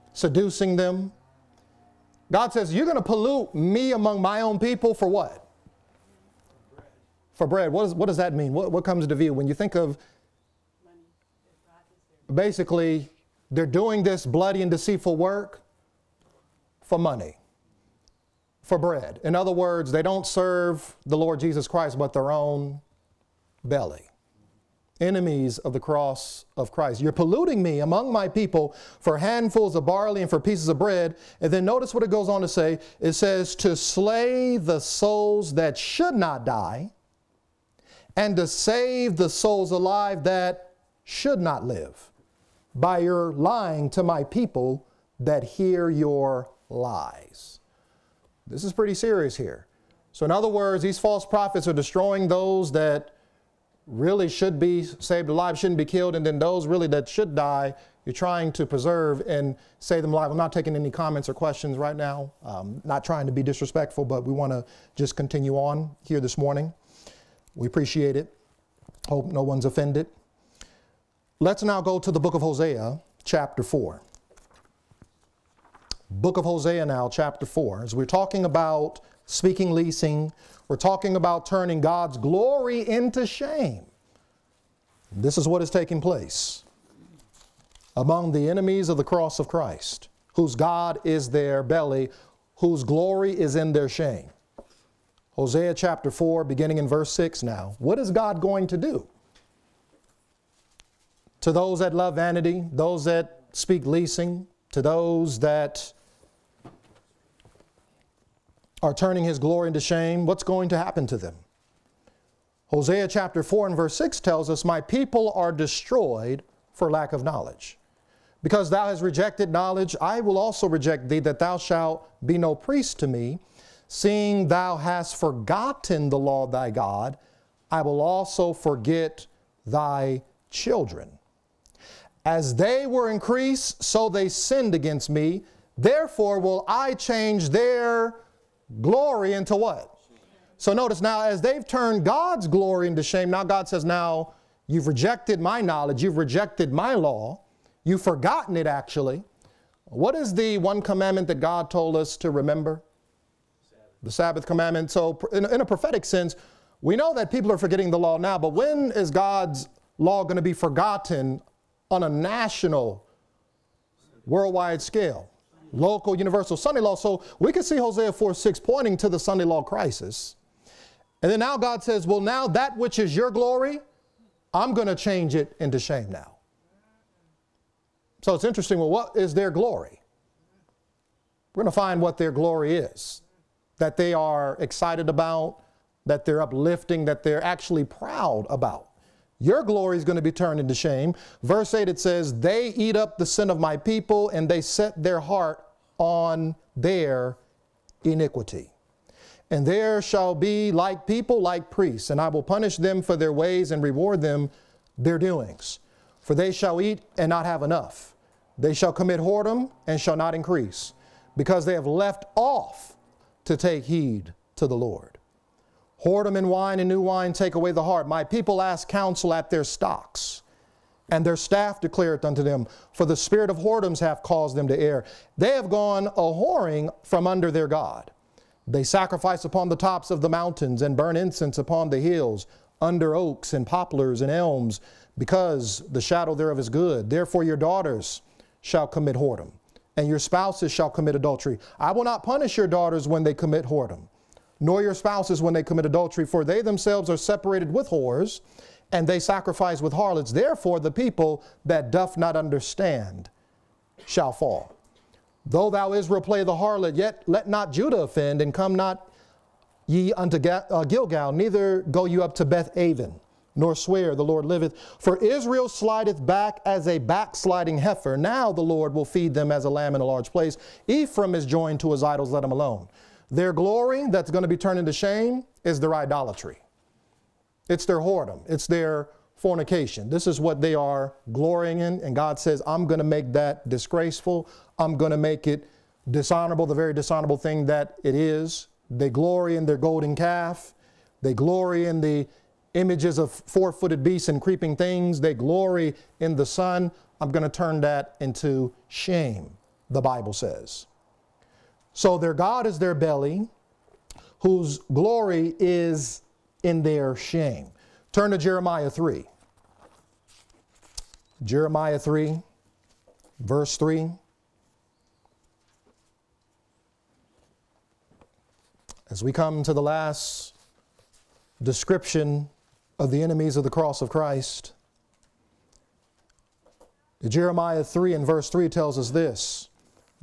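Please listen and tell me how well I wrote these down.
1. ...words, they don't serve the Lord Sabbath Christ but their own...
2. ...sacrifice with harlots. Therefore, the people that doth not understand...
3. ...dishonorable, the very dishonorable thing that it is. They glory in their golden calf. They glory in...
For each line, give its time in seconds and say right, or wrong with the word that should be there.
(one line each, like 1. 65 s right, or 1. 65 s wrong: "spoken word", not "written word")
1. 19 s wrong: "Jesus", not "Sabbath"
2. 249 s right
3. 286 s right.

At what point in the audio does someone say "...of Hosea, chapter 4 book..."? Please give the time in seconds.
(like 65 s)
72 s.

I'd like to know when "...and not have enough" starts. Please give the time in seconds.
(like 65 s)
207 s.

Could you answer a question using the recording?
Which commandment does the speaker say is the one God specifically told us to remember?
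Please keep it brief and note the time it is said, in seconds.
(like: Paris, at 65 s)
The Sabbath commandment, at 154 s.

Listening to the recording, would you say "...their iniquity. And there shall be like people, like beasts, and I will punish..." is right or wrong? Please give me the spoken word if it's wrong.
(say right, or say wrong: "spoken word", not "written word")
wrong: "priests", not "beasts".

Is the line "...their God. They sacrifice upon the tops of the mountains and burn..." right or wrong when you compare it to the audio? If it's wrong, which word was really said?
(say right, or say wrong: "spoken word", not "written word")
right.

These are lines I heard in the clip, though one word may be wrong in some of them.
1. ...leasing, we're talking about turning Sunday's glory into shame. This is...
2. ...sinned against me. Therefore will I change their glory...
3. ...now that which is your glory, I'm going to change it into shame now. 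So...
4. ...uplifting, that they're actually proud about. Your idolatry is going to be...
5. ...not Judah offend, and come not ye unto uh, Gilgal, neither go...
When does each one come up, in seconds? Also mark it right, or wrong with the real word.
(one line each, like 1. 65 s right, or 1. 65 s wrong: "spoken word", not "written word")
1. 79 s wrong: "God", not "Sunday"
2. 134 s right
3. 172 s right
4. 186 s wrong: "glory", not "idolatry"
5. 257 s right.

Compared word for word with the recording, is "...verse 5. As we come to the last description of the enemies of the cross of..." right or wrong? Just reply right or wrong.
wrong.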